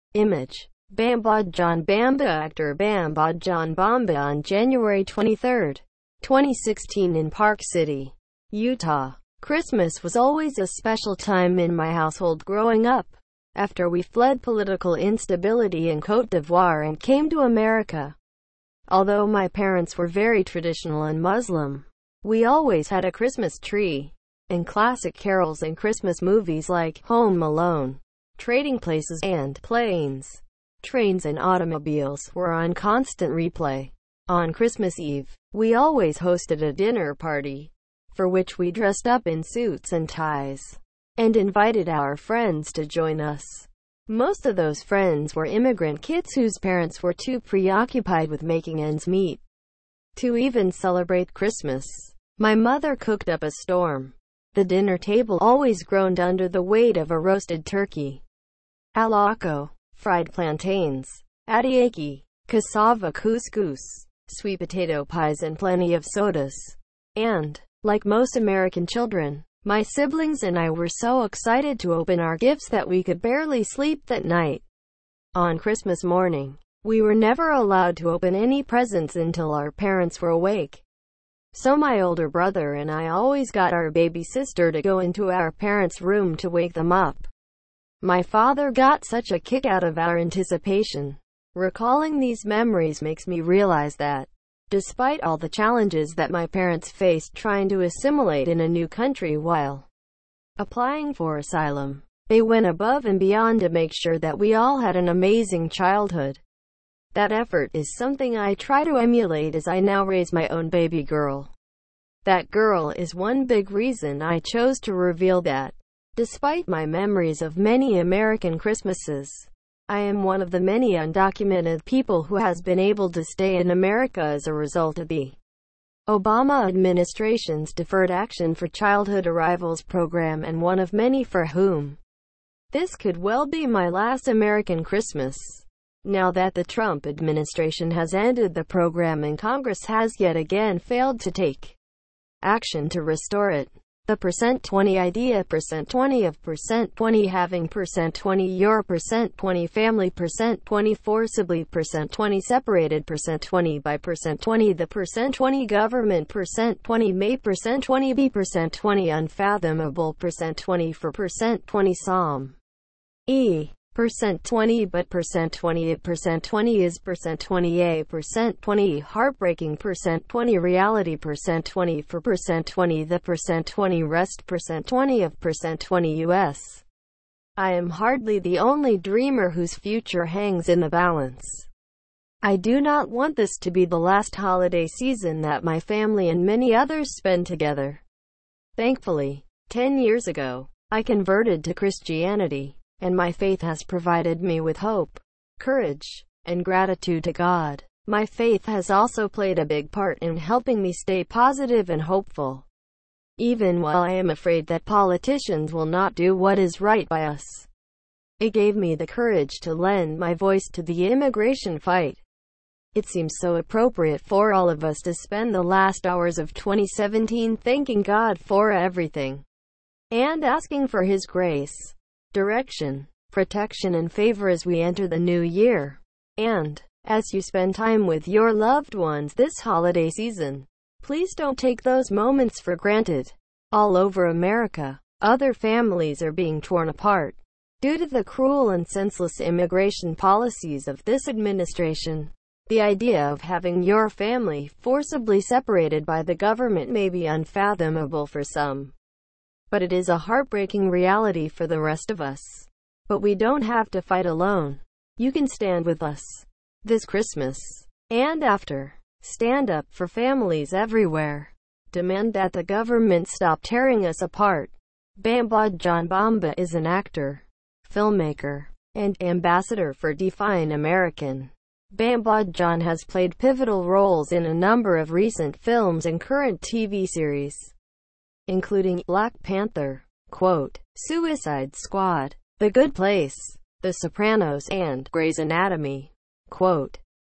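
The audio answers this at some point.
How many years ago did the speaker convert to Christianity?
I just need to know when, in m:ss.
3:09.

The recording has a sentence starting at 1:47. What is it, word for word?
That effort is something I try to emulate as I now raise my own baby girl.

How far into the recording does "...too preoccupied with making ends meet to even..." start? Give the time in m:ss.
0:47.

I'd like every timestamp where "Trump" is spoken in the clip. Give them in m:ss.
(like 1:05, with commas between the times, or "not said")
2:16.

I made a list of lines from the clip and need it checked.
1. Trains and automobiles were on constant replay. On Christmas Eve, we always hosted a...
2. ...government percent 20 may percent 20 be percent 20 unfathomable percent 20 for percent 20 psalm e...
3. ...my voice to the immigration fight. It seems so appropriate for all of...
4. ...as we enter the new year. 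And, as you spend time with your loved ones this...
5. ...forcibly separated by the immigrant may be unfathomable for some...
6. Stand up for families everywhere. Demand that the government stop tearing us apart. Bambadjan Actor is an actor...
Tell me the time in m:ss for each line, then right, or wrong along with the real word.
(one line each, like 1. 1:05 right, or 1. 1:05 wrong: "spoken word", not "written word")
1. 0:30 right
2. 2:35 right
3. 3:30 right
4. 3:44 right
5. 4:04 wrong: "government", not "immigrant"
6. 4:19 wrong: "Bamba", not "Actor".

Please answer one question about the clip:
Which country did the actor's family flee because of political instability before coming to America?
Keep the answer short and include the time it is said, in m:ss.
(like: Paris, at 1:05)
Cote d'Ivoire, at 0:16.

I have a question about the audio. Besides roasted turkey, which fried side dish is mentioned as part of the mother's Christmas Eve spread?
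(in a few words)
Fried plantains.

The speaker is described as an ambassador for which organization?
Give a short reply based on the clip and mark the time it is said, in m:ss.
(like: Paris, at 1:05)
Define American, at 4:30.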